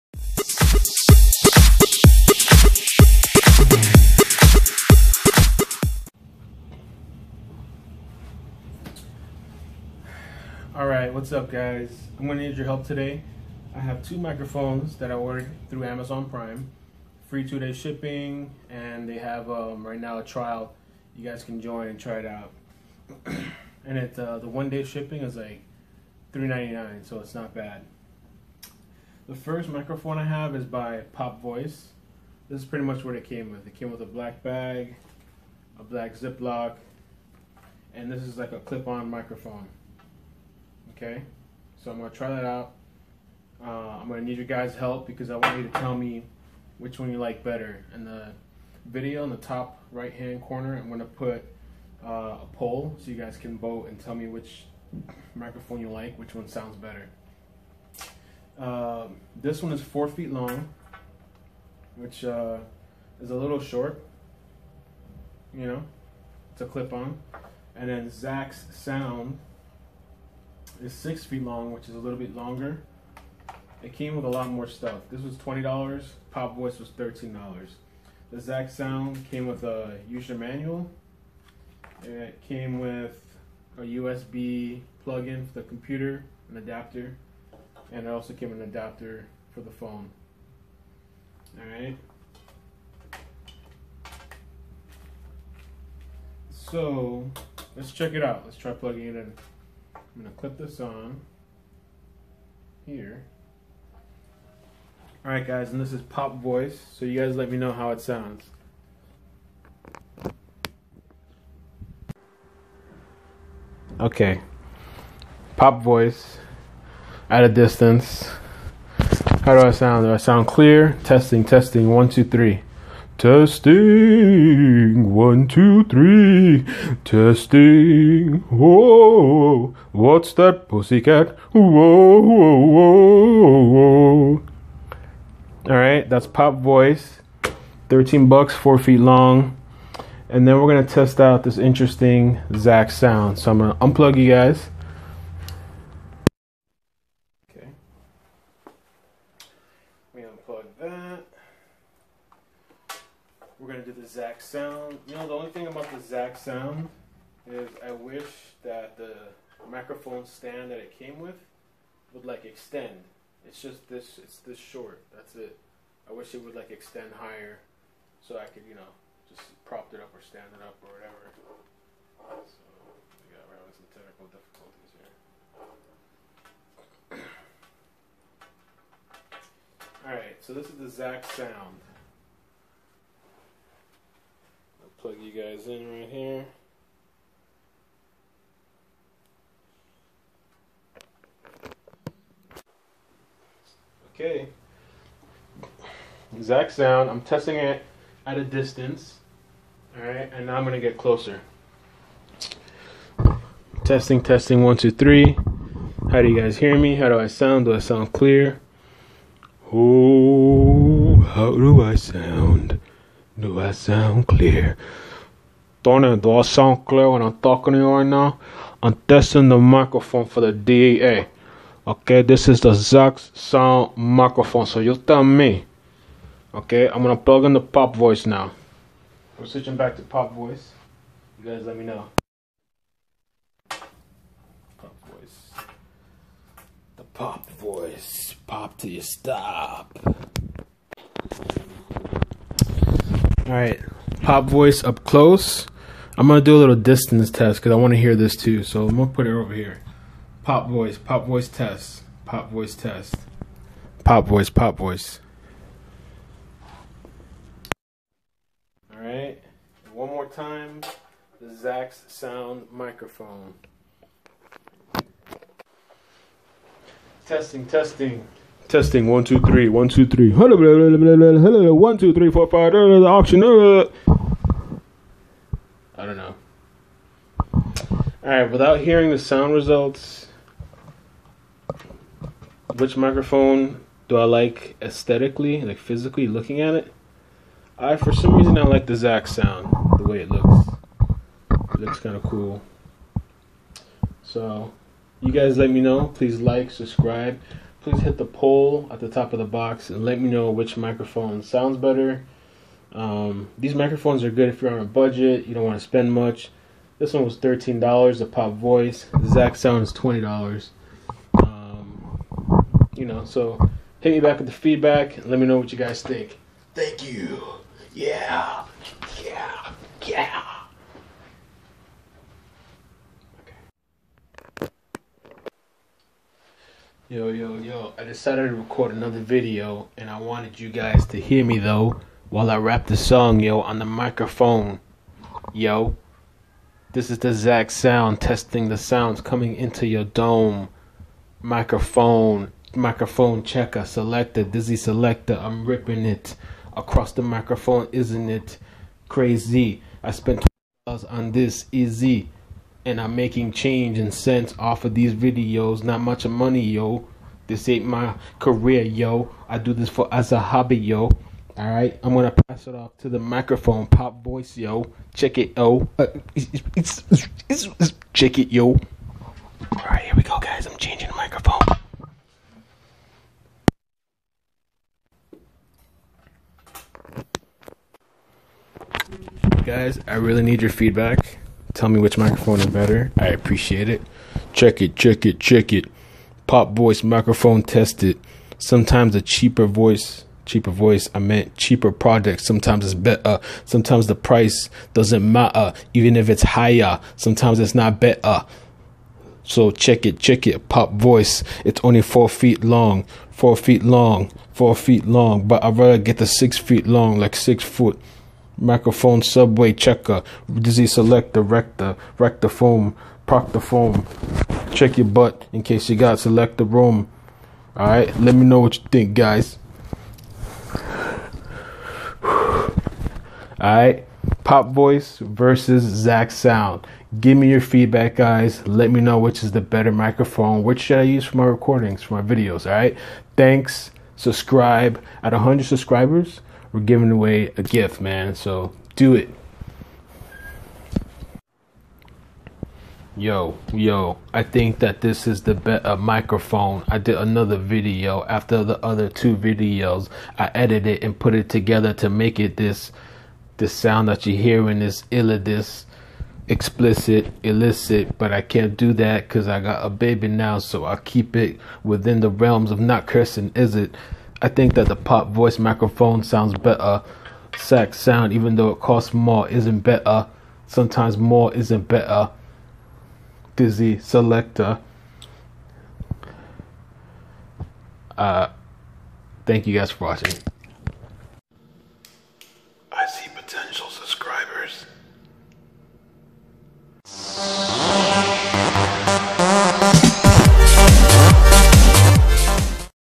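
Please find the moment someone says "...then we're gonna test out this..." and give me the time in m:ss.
2:20.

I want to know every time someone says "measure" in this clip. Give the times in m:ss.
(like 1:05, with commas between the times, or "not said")
not said.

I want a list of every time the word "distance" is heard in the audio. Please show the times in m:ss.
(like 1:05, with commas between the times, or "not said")
1:57, 3:18, 4:06.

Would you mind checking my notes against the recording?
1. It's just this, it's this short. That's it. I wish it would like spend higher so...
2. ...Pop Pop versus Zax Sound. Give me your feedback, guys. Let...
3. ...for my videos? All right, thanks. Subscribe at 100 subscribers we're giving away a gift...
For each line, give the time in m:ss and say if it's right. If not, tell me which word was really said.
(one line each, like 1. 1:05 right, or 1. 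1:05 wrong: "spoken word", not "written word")
1. 2:43 wrong: "extend", not "spend"
2. 7:04 wrong: "Voice", not "Pop"
3. 7:12 right.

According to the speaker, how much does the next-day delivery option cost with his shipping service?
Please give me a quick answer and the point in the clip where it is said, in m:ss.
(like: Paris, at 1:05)
$3.99, at 0:26.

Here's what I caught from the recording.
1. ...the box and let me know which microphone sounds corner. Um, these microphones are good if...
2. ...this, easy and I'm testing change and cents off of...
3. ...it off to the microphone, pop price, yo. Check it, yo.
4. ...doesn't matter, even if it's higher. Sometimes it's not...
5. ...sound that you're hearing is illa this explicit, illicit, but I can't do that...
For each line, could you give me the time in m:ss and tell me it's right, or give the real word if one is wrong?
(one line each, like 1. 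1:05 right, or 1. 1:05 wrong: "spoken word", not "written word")
1. 4:59 wrong: "better", not "corner"
2. 5:51 wrong: "making", not "testing"
3. 6:02 wrong: "voice", not "price"
4. 6:34 right
5. 7:33 right.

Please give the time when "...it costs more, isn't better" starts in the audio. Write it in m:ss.
7:48.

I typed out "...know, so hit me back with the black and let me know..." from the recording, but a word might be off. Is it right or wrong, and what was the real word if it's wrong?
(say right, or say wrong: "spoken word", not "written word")
wrong: "feedback", not "black".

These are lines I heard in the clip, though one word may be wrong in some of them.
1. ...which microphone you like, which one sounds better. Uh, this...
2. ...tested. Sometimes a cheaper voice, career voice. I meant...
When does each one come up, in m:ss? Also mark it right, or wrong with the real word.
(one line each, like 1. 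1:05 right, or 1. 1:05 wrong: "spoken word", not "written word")
1. 0:54 right
2. 6:27 wrong: "cheaper", not "career".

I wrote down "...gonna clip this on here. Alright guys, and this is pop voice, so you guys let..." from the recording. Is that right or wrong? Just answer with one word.
right.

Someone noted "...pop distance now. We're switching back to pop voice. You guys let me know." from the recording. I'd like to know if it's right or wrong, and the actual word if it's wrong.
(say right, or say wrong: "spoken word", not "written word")
wrong: "voice", not "distance".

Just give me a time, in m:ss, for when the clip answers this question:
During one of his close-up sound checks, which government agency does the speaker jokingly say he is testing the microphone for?
3:40.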